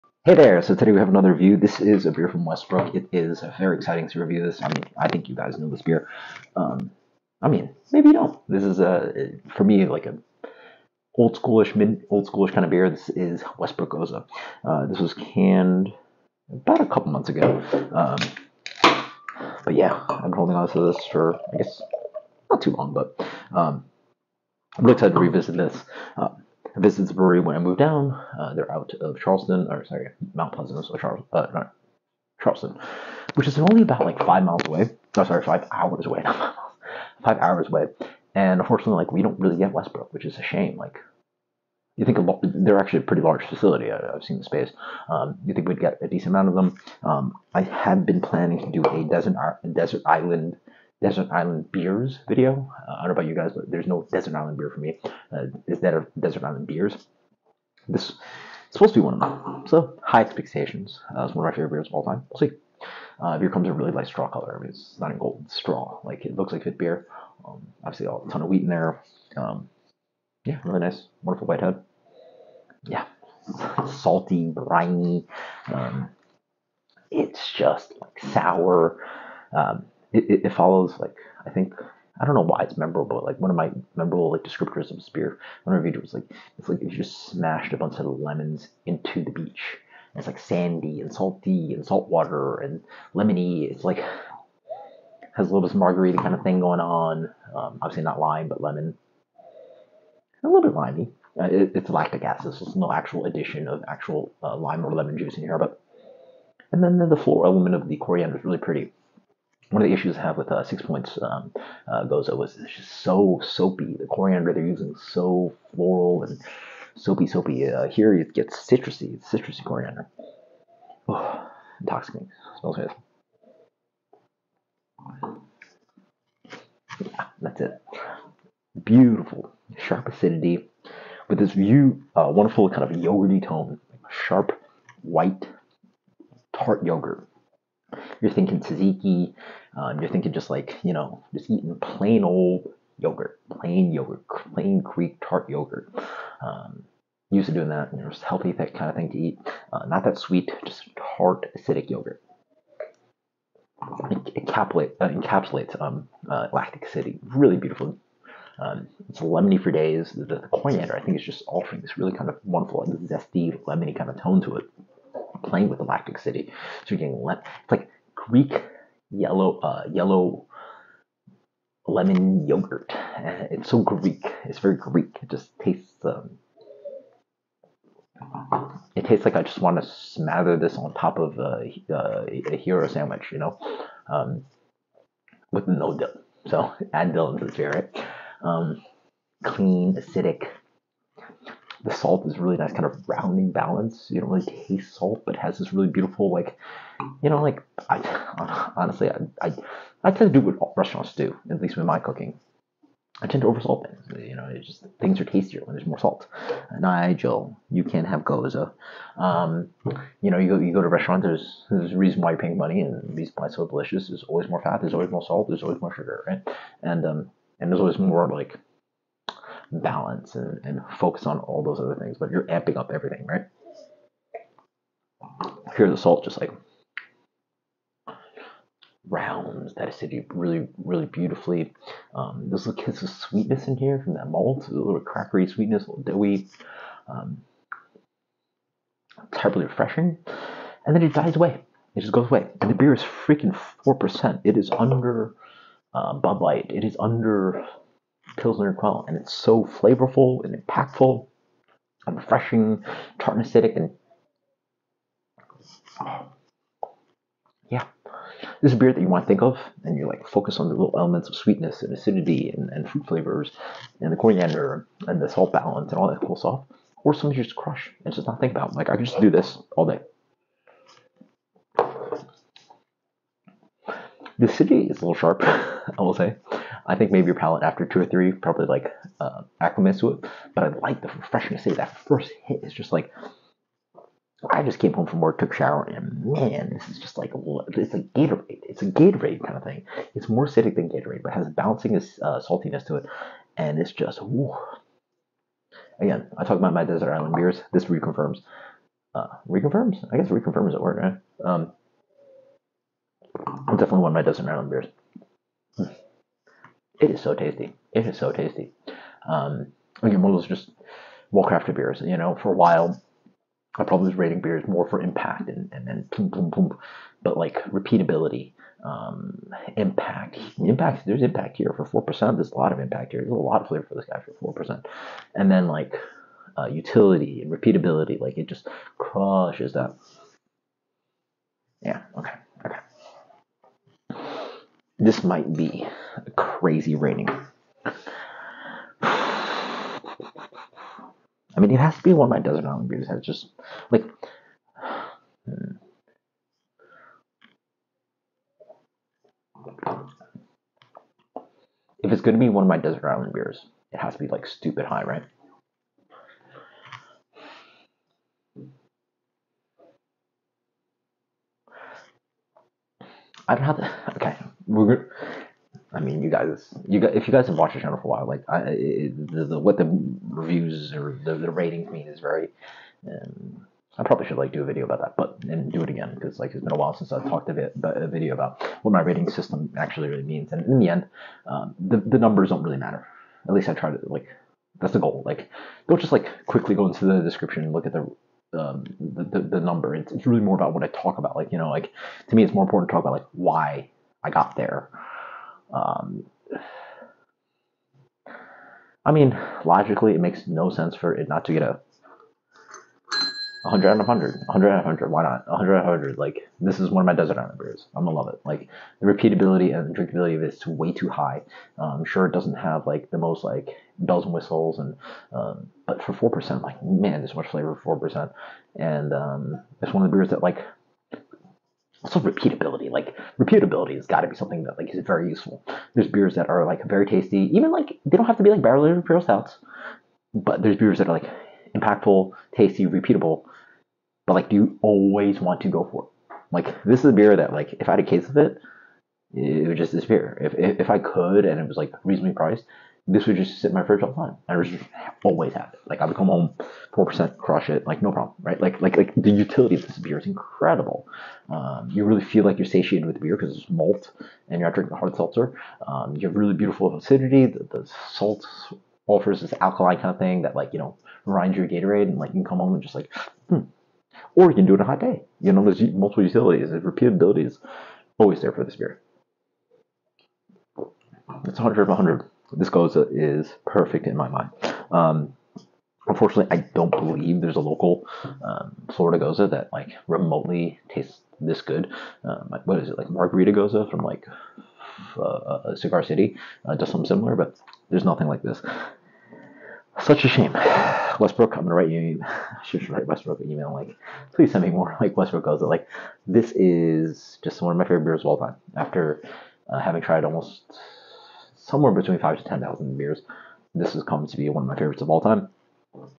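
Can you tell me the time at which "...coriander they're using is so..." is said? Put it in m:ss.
1:54.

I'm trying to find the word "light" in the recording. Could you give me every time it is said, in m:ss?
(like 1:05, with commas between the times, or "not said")
1:03, 4:06.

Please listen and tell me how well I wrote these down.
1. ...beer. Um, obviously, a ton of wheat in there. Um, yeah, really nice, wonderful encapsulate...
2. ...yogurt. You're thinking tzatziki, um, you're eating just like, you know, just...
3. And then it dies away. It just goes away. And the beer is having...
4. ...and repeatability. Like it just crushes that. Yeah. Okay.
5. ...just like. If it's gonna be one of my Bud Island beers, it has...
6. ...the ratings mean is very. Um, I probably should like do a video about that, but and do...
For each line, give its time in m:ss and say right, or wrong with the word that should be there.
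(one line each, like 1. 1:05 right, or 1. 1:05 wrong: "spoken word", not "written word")
1. 1:06 wrong: "white", not "encapsulate"
2. 2:16 wrong: "thinking", not "eating"
3. 4:00 wrong: "freaking", not "having"
4. 5:27 right
5. 5:43 wrong: "Desert", not "Bud"
6. 6:11 right.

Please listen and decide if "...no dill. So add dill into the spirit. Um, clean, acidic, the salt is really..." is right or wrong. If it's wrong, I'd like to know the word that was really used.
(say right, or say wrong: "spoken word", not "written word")
right.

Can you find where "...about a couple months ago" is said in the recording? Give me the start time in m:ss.
0:16.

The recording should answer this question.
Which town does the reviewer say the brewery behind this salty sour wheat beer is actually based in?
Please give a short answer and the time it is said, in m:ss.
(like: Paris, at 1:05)
Mount Pleasant, at 0:30.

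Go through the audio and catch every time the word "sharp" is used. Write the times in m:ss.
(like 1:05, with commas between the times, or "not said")
2:09, 2:14, 4:35.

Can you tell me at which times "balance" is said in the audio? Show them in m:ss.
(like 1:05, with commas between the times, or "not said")
3:13, 3:39, 4:25.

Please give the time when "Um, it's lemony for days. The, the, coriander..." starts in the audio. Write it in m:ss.
2:38.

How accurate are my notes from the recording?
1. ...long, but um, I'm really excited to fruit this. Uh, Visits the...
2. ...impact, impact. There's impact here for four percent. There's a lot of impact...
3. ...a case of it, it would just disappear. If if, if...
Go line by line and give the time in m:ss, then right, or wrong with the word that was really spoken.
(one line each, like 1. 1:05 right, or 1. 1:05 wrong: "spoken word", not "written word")
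1. 0:22 wrong: "revisit", not "fruit"
2. 5:19 right
3. 7:17 right.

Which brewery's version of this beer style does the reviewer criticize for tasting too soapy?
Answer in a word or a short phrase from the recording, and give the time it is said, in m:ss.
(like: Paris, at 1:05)
Six Points, at 1:50.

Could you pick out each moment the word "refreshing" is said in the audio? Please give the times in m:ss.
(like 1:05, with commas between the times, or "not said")
3:59, 4:12.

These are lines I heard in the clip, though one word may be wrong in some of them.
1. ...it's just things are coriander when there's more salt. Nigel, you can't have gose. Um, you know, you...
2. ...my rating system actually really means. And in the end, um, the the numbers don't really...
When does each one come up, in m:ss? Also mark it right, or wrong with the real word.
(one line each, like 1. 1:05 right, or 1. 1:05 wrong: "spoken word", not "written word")
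1. 3:24 wrong: "tastier", not "coriander"
2. 6:18 right.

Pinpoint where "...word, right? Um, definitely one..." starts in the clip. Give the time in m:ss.
5:00.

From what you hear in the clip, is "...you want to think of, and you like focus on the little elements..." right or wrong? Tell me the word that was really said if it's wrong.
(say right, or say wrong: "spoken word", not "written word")
right.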